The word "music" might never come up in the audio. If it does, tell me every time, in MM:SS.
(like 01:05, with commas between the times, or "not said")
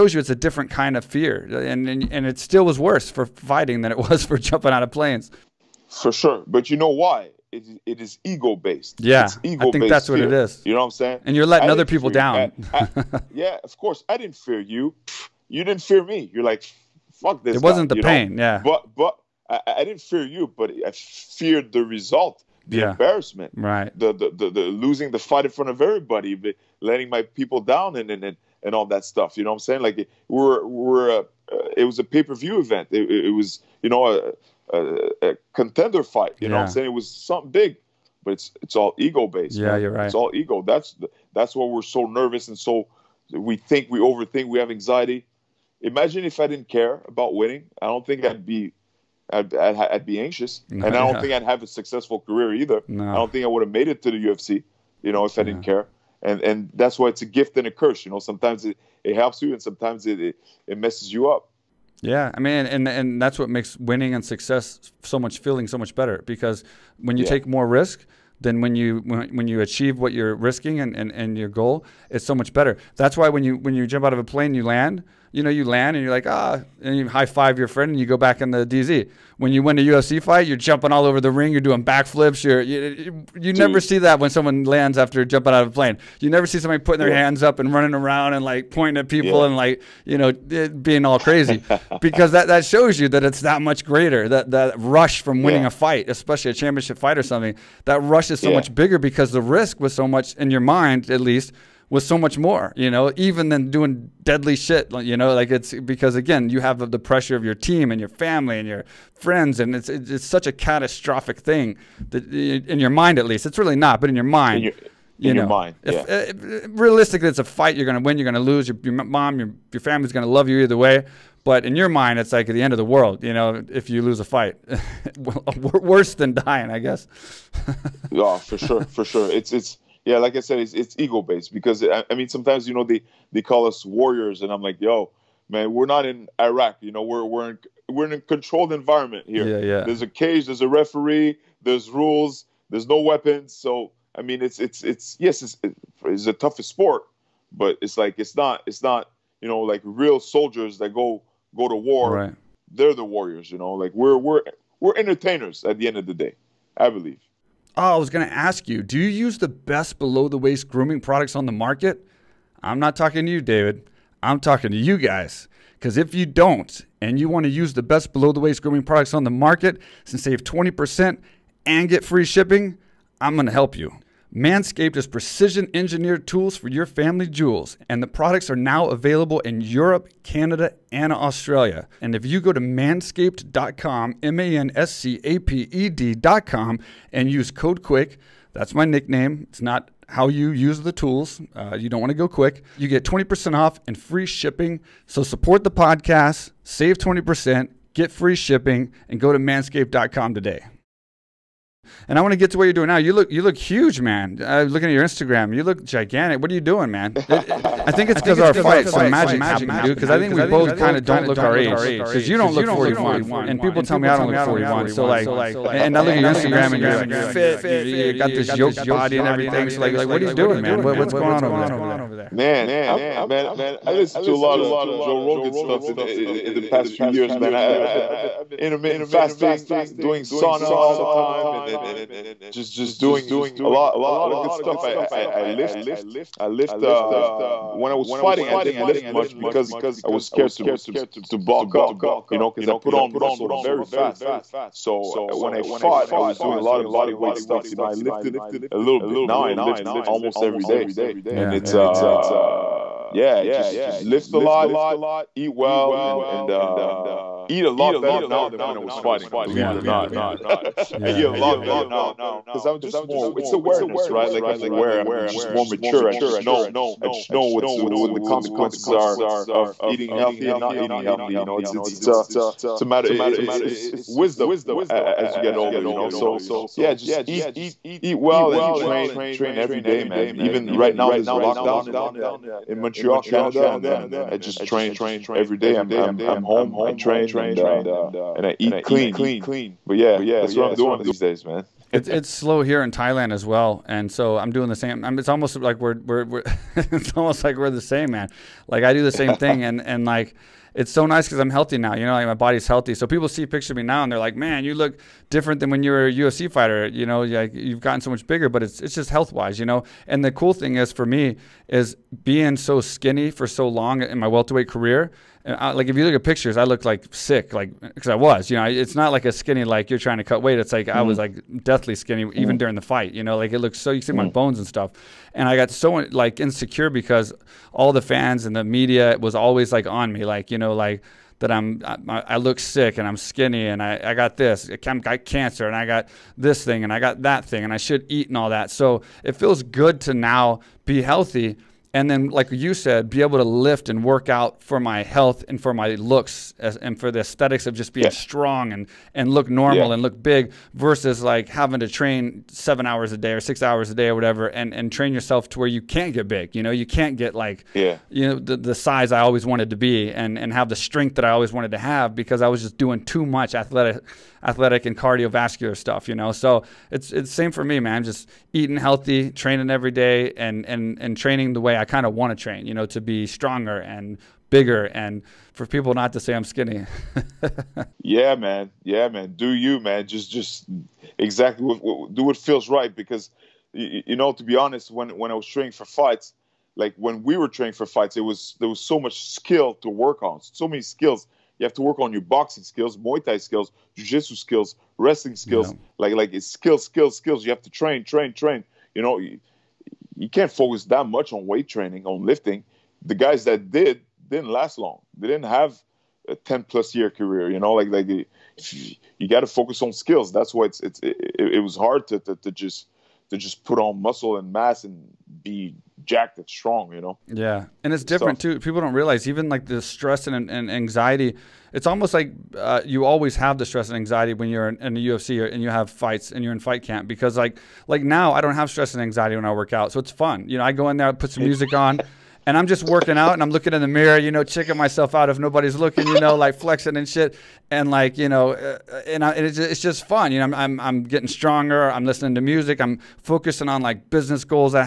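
07:11, 07:22.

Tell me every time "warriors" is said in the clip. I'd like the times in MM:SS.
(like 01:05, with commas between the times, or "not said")
02:13, 02:33.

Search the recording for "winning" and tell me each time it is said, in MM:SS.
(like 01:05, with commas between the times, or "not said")
00:47, 01:03, 01:35.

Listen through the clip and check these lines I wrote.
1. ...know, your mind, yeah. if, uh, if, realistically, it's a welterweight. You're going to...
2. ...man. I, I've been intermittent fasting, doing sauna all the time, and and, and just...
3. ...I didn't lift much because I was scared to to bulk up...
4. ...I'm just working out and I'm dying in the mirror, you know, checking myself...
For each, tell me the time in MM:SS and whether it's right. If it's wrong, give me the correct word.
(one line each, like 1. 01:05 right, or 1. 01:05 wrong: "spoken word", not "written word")
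1. 01:55 wrong: "fight", not "welterweight"
2. 03:47 right
3. 03:58 right
4. 07:12 wrong: "looking", not "dying".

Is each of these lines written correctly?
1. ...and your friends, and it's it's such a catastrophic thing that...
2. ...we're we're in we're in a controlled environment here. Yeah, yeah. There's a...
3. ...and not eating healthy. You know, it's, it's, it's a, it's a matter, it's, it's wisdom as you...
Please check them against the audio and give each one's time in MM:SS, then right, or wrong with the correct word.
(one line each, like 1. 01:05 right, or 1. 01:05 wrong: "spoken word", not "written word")
1. 01:48 right
2. 02:17 right
3. 04:30 right.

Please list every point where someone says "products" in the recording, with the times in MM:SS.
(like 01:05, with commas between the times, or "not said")
02:40, 02:48, 02:58.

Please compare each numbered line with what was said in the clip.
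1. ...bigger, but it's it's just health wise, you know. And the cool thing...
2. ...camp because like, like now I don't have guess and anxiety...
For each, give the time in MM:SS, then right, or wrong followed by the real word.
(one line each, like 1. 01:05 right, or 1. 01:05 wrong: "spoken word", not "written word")
1. 05:08 right
2. 07:06 wrong: "stress", not "guess".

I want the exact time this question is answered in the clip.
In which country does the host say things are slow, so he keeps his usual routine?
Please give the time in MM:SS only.
04:52.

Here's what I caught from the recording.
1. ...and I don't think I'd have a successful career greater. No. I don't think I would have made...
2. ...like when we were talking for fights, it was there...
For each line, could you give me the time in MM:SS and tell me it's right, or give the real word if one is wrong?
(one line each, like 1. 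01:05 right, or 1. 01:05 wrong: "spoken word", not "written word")
1. 00:50 wrong: "either", not "greater"
2. 06:26 wrong: "training", not "talking".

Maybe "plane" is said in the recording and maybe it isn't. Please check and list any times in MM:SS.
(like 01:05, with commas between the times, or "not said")
00:04, 01:14, 01:25.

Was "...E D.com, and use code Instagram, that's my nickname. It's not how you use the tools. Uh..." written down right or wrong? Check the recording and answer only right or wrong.
wrong.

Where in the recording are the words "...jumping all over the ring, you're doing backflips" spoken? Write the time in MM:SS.
01:20.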